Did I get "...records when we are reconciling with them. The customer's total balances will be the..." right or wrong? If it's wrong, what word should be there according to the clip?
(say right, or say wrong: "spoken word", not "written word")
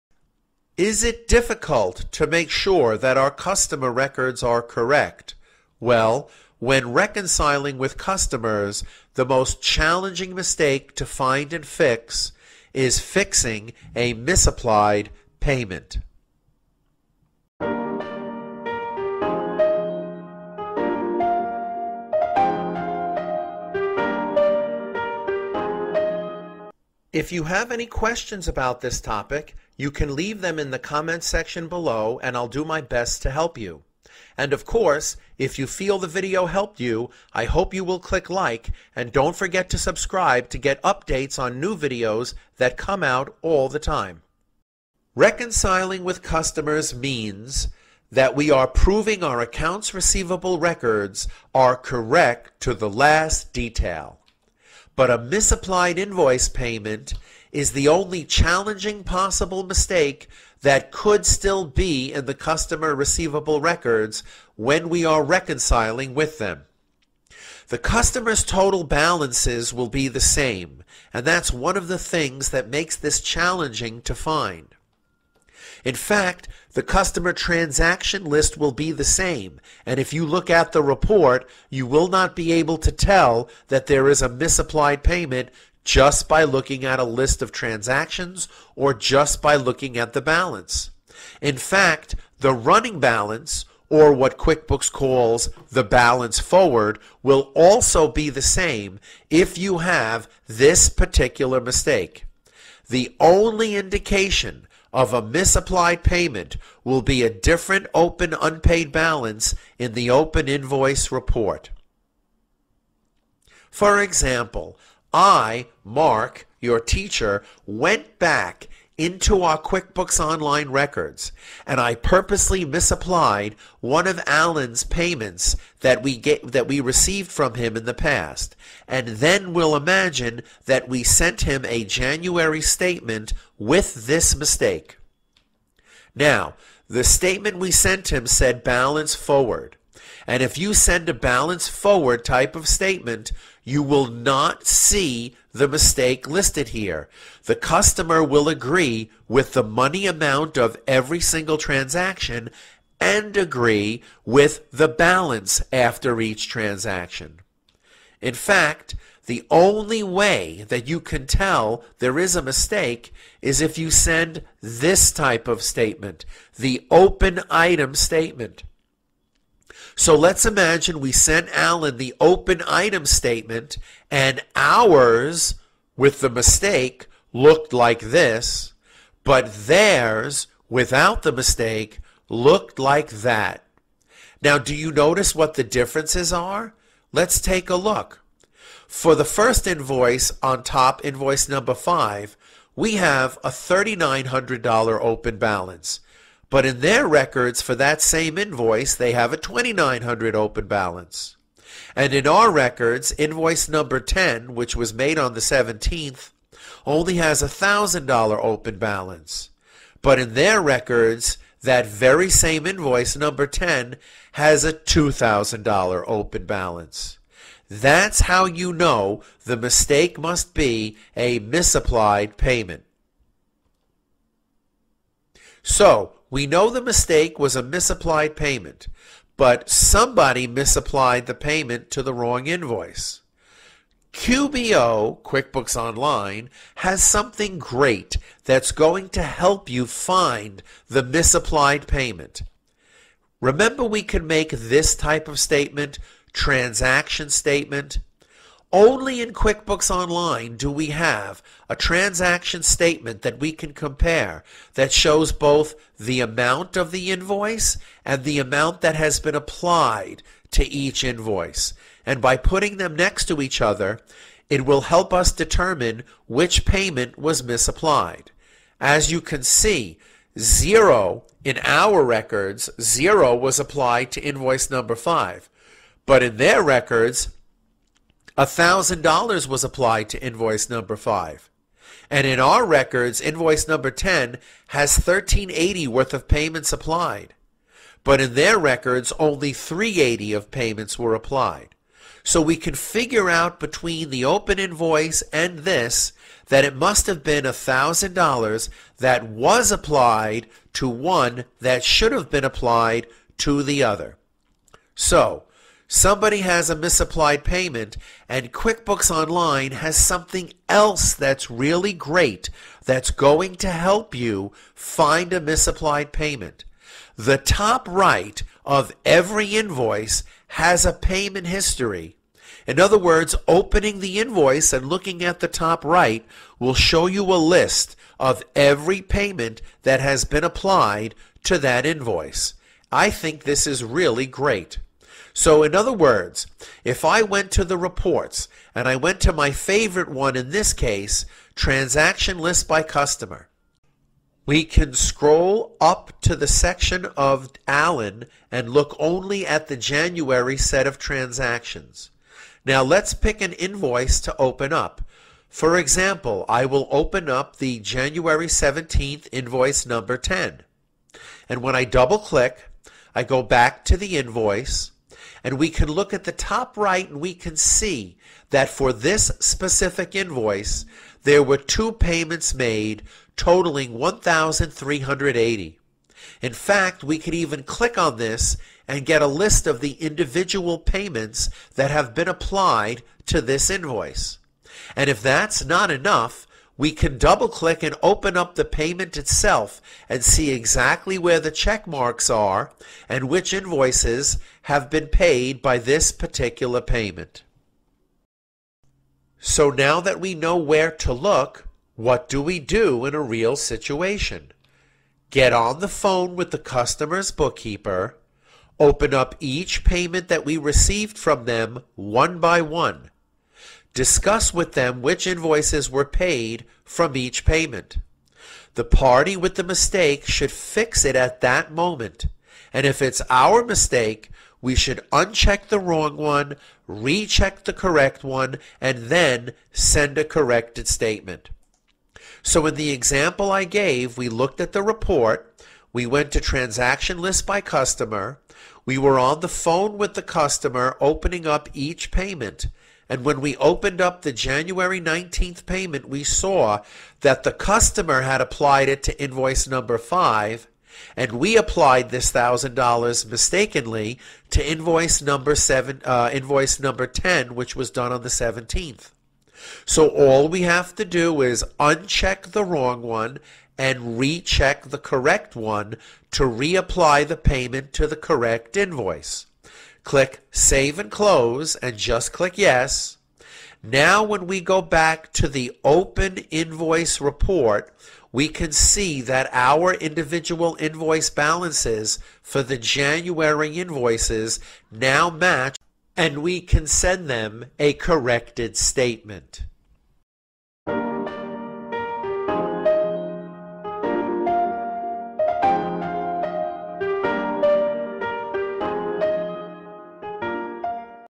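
right.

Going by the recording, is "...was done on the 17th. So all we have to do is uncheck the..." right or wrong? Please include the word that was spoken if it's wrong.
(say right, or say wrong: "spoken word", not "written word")
right.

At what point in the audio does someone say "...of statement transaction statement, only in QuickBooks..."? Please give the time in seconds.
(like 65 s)
245 s.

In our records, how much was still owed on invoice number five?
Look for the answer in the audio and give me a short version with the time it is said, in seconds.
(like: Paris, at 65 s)
$3,900, at 193 s.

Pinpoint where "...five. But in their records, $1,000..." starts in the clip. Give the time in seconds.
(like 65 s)
274 s.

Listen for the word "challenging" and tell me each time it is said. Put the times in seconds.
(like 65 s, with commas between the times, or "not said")
9 s, 58 s, 73 s.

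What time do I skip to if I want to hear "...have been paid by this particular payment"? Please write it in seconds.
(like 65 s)
394 s.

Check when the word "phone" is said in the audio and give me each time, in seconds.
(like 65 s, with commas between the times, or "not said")
405 s, 439 s.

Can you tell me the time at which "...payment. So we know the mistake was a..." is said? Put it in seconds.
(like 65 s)
222 s.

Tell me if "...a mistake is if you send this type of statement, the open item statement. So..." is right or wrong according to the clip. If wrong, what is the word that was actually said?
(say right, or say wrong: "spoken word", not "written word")
right.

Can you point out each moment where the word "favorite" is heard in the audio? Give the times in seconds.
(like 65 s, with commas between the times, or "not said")
339 s.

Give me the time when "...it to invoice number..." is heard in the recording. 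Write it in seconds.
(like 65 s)
448 s.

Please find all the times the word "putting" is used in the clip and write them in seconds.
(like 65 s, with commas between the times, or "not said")
262 s.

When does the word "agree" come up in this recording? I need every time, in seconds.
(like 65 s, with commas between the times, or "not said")
148 s, 153 s.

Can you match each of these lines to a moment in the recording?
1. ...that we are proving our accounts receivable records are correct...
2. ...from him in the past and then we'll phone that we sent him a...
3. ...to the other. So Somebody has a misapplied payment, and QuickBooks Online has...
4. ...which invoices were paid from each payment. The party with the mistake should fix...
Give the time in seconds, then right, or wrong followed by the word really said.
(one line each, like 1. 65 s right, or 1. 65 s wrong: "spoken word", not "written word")
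1. 48 s right
2. 127 s wrong: "imagine", not "phone"
3. 303 s right
4. 415 s right.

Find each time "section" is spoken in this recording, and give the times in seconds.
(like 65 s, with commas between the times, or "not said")
31 s, 346 s.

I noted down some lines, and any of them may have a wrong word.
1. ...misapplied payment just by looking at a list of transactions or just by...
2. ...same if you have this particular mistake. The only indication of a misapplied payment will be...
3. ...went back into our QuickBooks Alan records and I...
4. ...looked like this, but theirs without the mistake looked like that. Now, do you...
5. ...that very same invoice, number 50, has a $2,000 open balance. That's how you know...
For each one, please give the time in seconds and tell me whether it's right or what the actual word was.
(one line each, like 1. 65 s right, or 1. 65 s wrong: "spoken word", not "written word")
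1. 84 s right
2. 98 s right
3. 117 s wrong: "Online", not "Alan"
4. 177 s right
5. 211 s wrong: "10", not "50".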